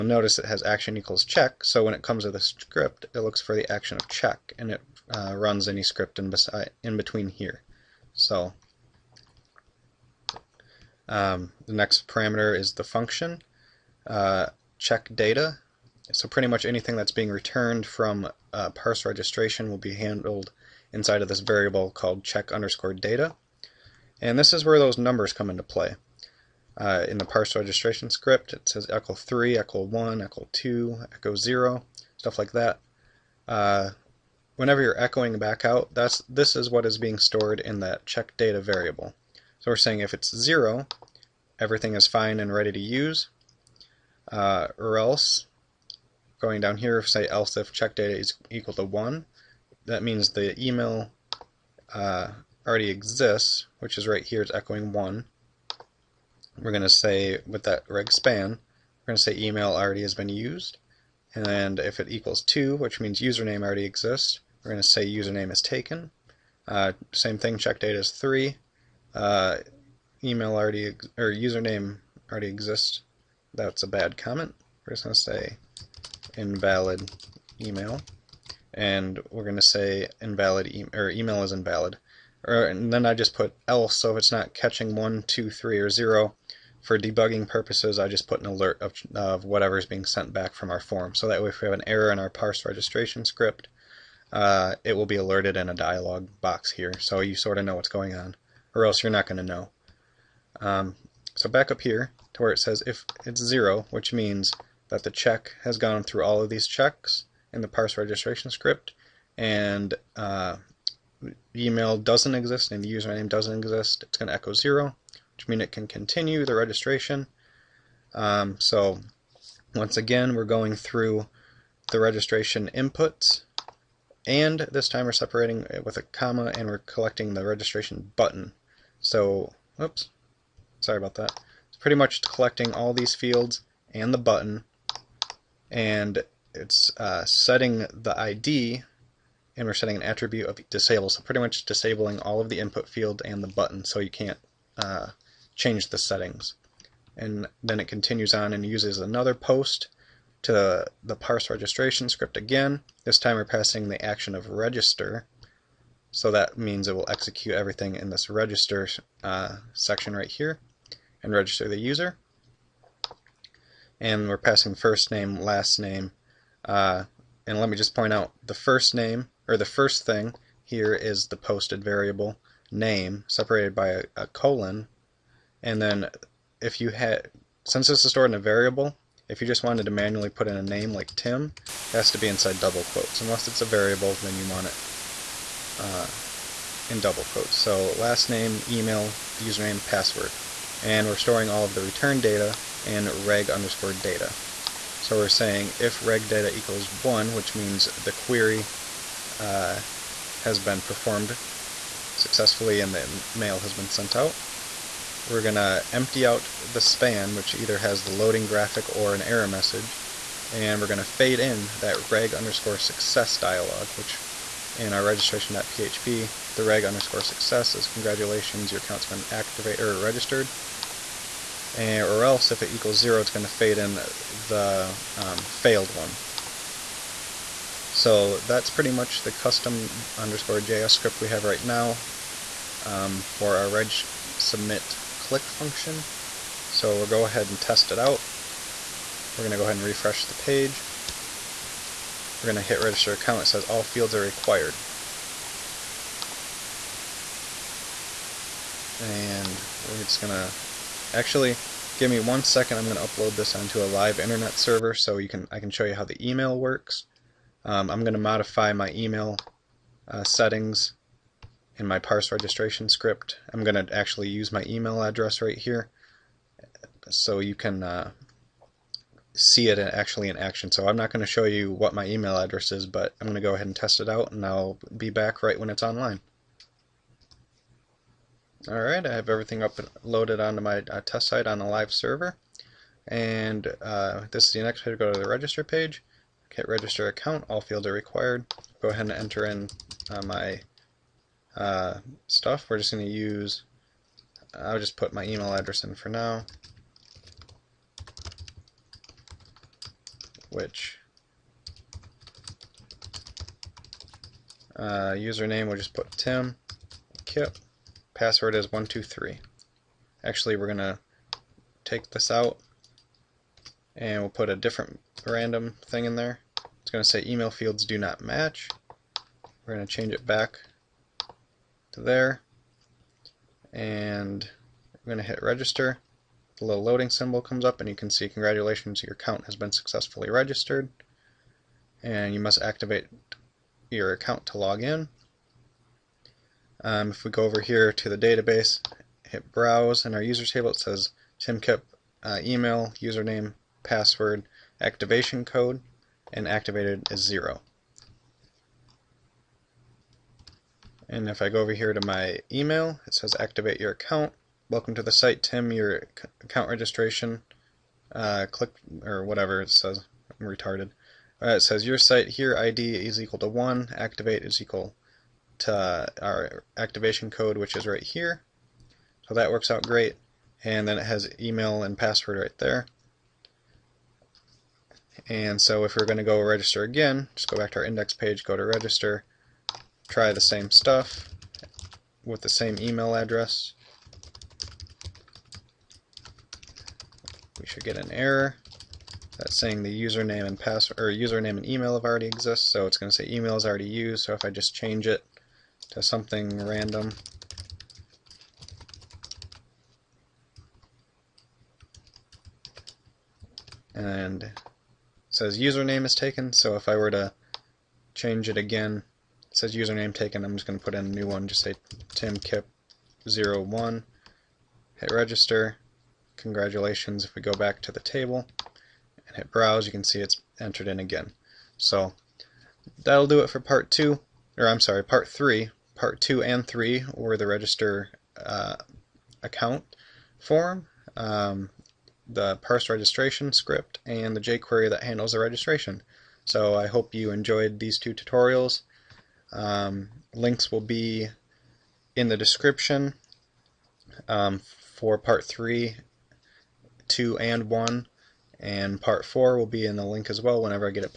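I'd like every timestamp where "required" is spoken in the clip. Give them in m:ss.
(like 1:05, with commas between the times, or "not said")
4:04, 4:47.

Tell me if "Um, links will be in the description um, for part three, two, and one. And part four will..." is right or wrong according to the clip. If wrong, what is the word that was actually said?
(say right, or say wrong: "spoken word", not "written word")
right.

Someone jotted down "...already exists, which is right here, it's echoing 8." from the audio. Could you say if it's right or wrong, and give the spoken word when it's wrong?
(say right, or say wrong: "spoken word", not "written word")
wrong: "1", not "8".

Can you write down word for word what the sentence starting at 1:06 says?
Uh, same thing, check data is 3.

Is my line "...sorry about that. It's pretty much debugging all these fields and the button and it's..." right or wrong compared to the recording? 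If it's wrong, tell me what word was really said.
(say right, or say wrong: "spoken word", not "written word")
wrong: "collecting", not "debugging".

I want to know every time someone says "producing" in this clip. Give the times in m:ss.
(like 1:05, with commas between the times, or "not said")
not said.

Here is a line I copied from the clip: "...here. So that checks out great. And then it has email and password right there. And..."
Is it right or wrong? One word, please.
wrong.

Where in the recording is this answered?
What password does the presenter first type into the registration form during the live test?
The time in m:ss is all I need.
5:08.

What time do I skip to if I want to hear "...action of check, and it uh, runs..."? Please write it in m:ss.
0:03.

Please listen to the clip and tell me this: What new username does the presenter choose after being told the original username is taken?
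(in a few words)
timkipp01.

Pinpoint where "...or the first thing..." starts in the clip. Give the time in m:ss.
2:49.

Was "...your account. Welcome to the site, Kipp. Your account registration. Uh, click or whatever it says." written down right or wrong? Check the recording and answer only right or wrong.
wrong.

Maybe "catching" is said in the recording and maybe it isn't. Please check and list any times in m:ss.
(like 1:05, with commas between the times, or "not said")
1:24.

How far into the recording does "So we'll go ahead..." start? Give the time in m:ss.
3:56.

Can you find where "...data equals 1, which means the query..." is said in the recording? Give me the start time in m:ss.
3:16.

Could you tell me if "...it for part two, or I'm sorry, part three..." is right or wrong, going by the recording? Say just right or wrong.
right.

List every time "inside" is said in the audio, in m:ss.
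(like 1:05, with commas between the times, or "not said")
0:20, 3:02.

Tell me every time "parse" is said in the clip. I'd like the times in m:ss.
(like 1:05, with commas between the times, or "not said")
0:18, 0:27, 1:32, 1:47, 2:31, 4:21, 7:12.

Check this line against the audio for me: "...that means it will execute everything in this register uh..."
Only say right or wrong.
right.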